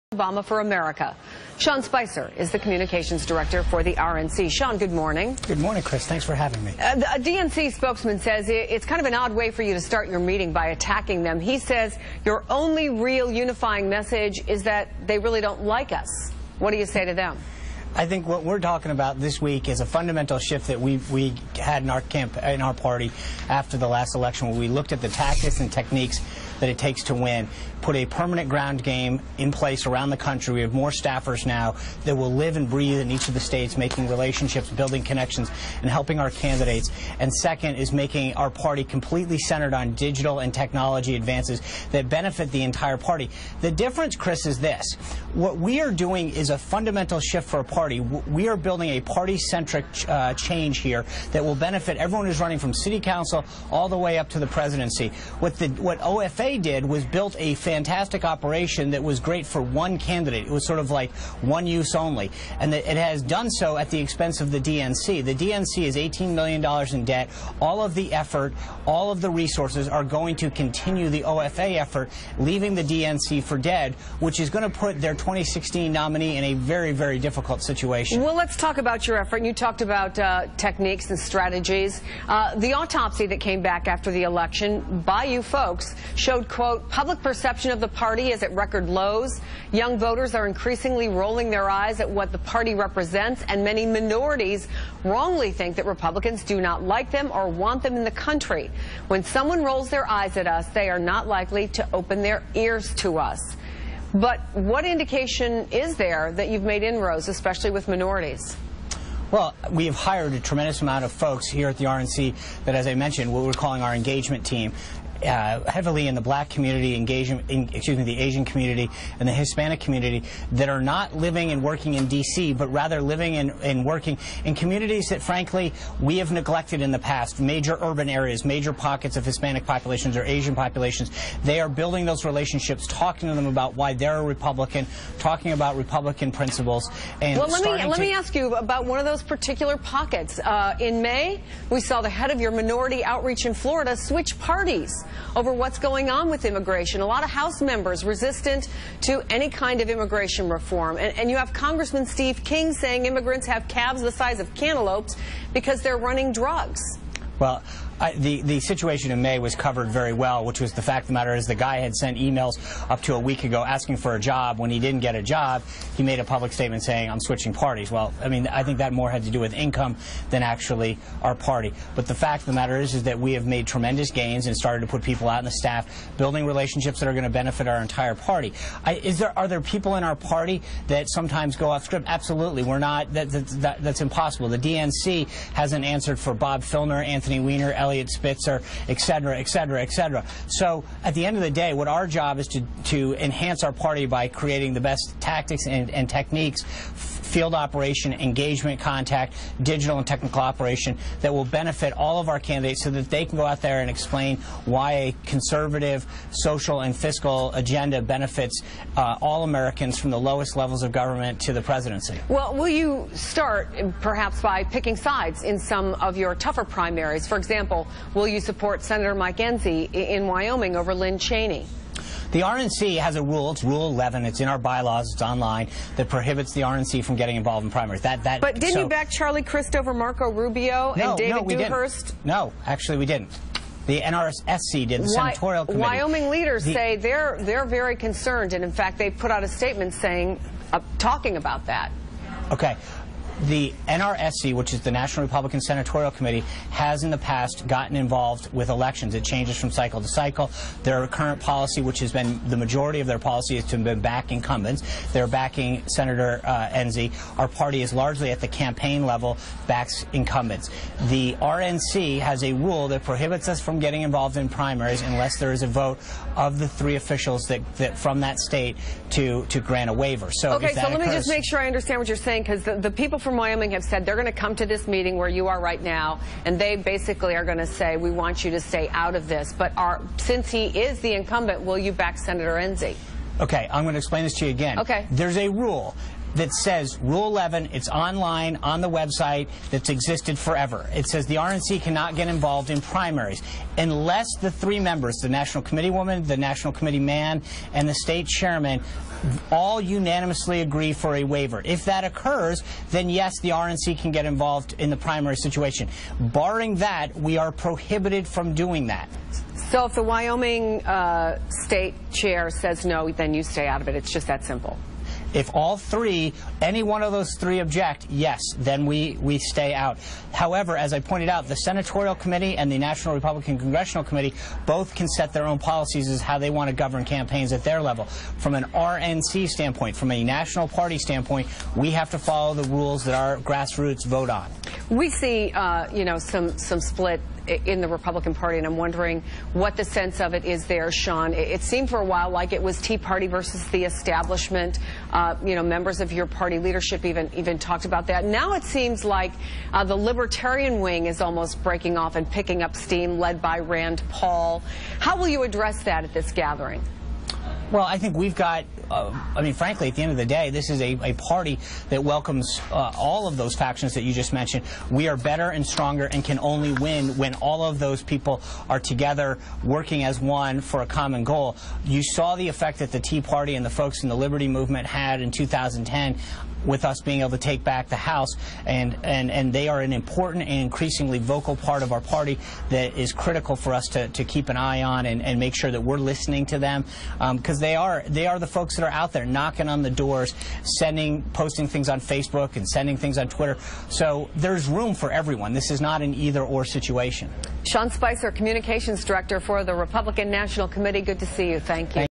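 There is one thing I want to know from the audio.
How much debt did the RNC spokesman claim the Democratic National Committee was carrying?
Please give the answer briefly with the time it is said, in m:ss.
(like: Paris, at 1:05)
$18 million, at 1:05.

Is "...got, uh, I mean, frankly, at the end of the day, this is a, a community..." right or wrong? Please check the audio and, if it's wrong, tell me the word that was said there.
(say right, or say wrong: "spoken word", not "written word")
wrong: "party", not "community".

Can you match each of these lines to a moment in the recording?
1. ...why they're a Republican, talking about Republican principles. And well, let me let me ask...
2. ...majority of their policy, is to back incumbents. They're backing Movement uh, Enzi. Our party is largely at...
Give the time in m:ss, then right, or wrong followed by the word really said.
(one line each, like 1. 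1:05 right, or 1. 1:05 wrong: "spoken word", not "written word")
1. 2:13 right
2. 4:12 wrong: "Senator", not "Movement".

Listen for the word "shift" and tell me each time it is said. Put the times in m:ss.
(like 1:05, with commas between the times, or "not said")
0:20, 0:47.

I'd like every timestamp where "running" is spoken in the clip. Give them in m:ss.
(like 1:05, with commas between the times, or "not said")
0:52, 2:35.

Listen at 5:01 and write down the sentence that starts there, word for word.
If that occurs, then yes, the RNC can get involved in the primary situation.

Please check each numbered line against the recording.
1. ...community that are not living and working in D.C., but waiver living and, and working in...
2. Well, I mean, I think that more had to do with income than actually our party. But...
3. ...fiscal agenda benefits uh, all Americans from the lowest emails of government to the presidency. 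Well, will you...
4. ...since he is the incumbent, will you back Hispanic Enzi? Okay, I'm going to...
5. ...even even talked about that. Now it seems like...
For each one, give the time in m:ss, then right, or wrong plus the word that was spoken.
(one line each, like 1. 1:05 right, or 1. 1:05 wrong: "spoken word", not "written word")
1. 1:59 wrong: "rather", not "waiver"
2. 2:47 right
3. 3:26 wrong: "levels", not "emails"
4. 4:40 wrong: "Senator", not "Hispanic"
5. 5:47 right.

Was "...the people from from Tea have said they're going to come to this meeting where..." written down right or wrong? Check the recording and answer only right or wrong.
wrong.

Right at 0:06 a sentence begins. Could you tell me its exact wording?
Uh, the, a DNC spokesman says it's kind of an odd way for you to start your meeting by attacking them.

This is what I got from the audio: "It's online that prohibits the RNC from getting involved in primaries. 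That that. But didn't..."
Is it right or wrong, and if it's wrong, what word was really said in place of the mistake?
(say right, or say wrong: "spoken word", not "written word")
right.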